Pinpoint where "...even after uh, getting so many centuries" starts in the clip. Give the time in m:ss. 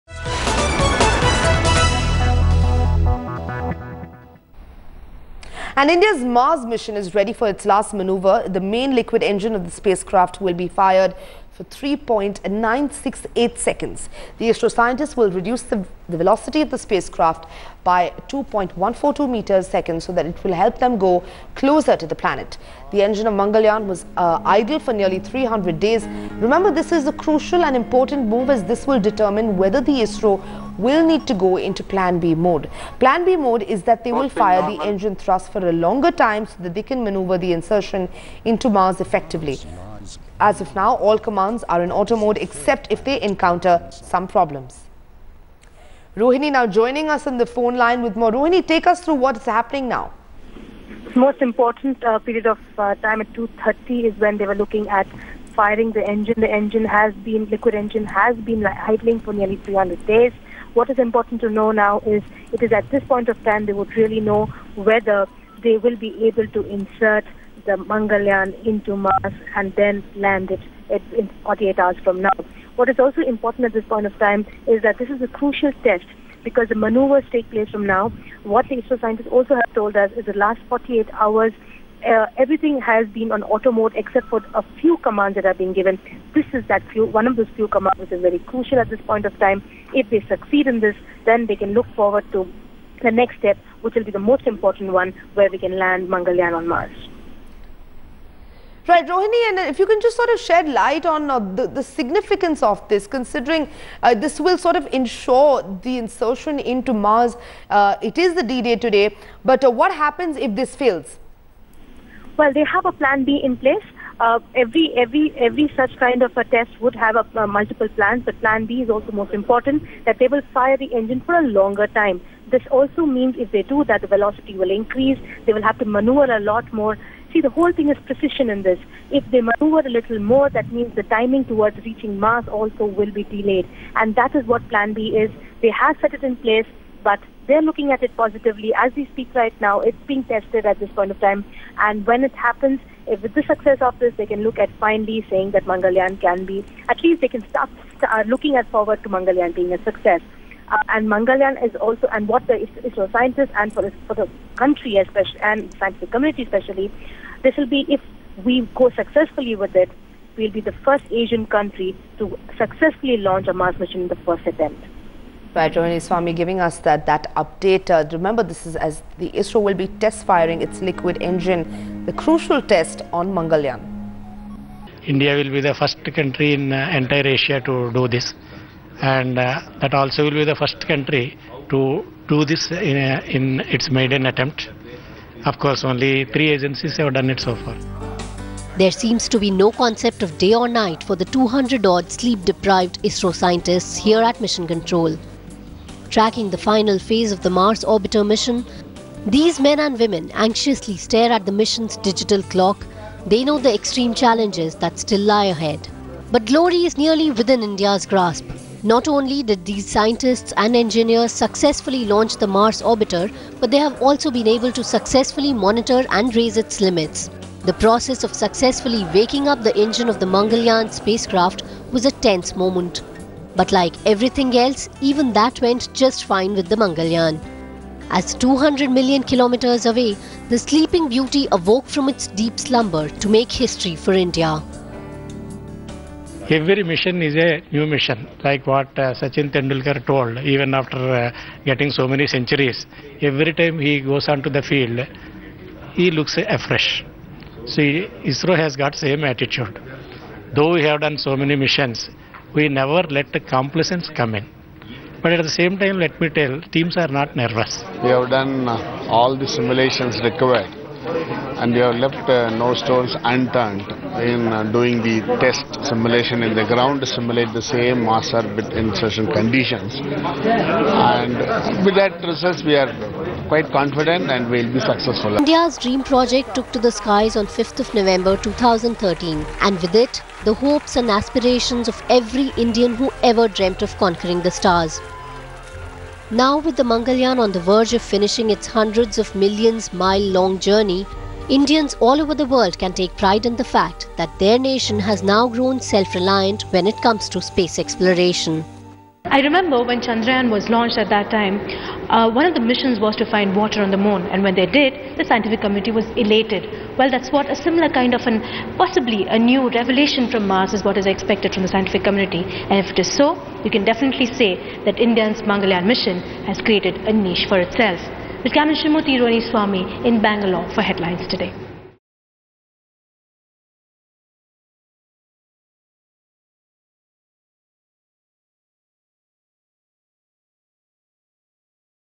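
4:00.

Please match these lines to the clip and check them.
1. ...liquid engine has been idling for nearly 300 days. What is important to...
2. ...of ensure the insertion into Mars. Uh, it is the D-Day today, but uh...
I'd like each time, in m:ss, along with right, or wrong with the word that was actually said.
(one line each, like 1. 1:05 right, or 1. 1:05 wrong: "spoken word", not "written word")
1. 0:57 right
2. 1:44 right.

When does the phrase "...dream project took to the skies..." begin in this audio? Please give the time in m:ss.
4:35.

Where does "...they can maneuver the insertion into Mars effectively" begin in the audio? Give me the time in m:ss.
0:36.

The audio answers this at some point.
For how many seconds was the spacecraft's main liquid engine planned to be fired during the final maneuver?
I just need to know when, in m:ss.
0:11.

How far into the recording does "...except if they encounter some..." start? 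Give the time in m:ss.
0:42.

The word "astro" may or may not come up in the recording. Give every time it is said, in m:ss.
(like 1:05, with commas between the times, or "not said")
0:14, 1:18.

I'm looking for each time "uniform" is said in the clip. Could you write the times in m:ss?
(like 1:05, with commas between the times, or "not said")
not said.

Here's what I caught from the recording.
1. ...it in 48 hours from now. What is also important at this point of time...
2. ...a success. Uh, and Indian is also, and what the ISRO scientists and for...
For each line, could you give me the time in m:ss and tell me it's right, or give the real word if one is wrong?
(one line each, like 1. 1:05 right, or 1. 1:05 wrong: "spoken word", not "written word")
1. 1:10 right
2. 2:29 wrong: "Mangalyaan", not "Indian".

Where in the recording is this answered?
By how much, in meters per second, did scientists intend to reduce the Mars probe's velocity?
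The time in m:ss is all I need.
0:18.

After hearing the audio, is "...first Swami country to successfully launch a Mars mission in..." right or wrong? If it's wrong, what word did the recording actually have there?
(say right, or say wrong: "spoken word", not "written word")
wrong: "Asian", not "Swami".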